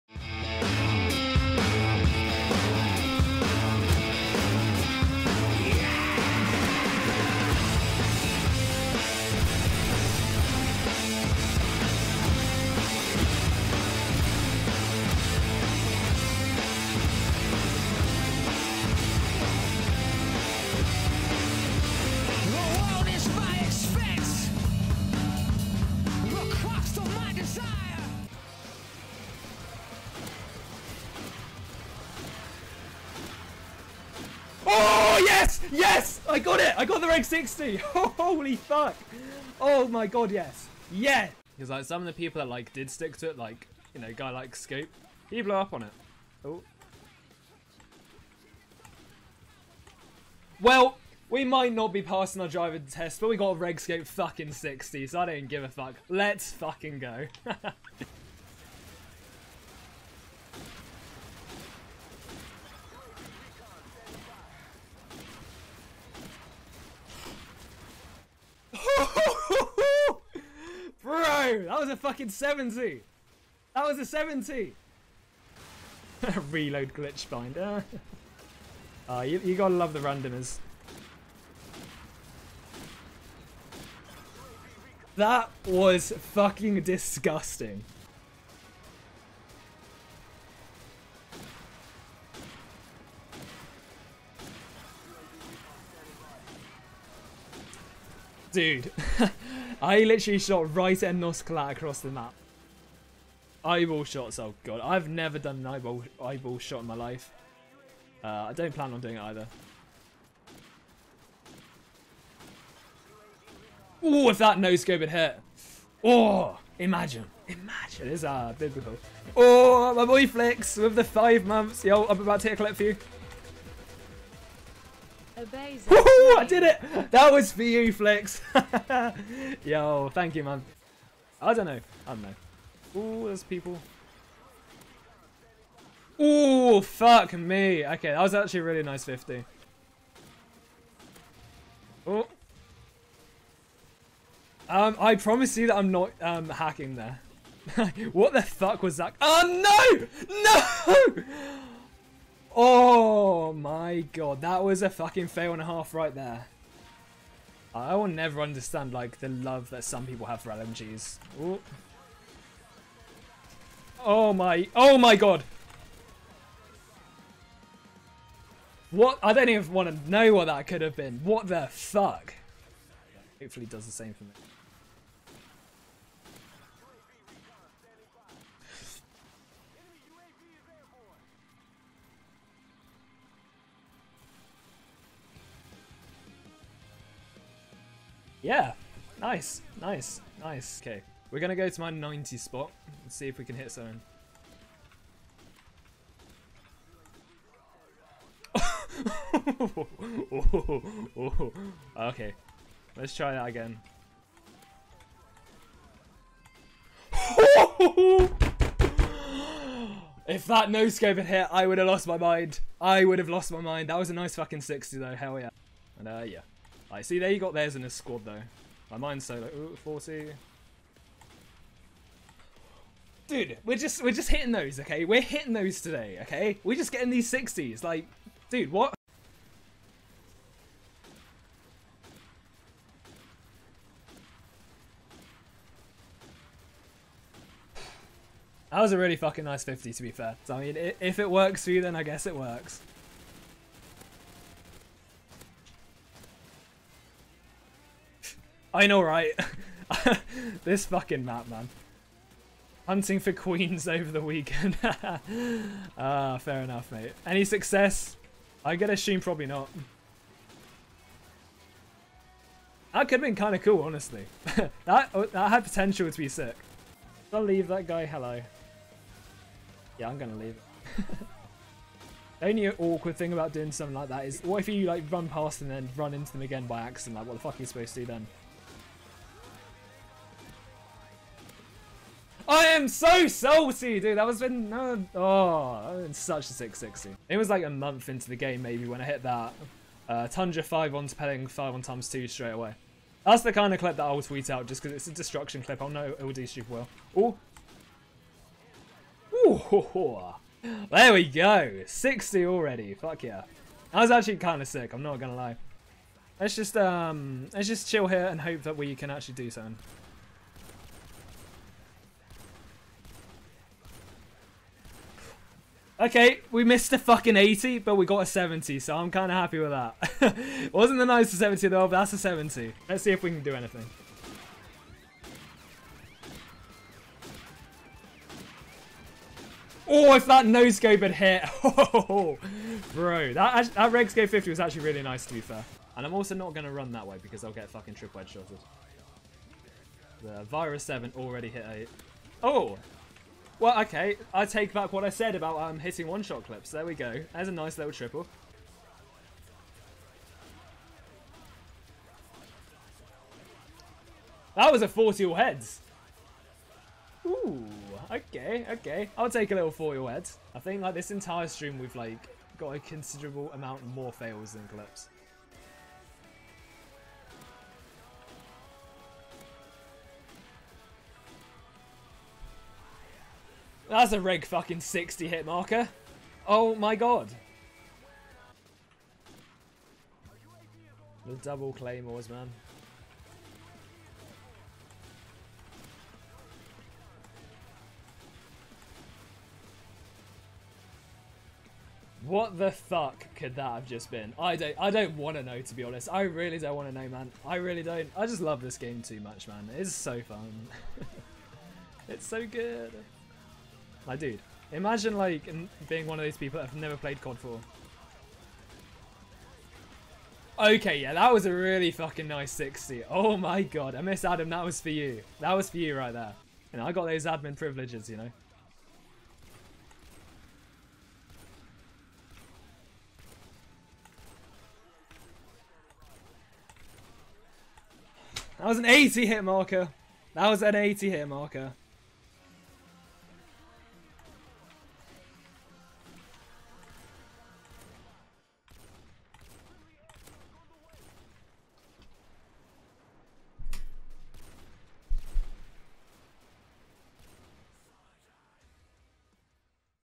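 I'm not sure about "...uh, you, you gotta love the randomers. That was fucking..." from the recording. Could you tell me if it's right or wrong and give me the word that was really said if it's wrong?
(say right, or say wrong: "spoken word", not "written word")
right.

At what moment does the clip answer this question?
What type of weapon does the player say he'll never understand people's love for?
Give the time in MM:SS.
02:40.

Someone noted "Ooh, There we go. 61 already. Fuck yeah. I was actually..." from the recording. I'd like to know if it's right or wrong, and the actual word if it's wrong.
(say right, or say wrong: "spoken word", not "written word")
wrong: "60", not "61".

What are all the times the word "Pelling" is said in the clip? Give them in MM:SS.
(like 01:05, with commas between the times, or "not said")
04:51.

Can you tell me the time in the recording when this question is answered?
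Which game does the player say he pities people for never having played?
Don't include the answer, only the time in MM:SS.
06:47.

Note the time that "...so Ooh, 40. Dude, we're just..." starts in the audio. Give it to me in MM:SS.
03:39.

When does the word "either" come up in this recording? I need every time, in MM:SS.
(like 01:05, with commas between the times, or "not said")
01:49.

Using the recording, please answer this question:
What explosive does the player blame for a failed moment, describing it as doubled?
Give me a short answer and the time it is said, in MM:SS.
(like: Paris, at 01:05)
claymores, at 06:21.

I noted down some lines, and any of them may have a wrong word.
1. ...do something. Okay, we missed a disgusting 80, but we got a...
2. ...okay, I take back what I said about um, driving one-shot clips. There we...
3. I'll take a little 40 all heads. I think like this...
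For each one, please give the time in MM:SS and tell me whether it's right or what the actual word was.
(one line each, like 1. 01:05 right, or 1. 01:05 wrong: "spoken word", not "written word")
1. 05:09 wrong: "fucking", not "disgusting"
2. 05:43 wrong: "hitting", not "driving"
3. 05:59 right.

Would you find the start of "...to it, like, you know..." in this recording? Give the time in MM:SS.
00:43.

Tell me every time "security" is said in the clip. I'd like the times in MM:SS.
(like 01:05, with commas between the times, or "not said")
not said.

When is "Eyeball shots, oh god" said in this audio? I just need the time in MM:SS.
01:43.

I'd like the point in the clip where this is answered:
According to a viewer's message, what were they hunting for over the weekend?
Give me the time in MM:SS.
04:13.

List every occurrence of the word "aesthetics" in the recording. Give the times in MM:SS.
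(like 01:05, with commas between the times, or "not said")
not said.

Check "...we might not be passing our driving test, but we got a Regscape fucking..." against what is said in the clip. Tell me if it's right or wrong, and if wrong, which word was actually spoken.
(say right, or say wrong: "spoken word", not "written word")
right.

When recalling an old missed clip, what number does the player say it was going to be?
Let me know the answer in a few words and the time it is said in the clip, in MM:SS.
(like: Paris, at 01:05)
660, at 04:46.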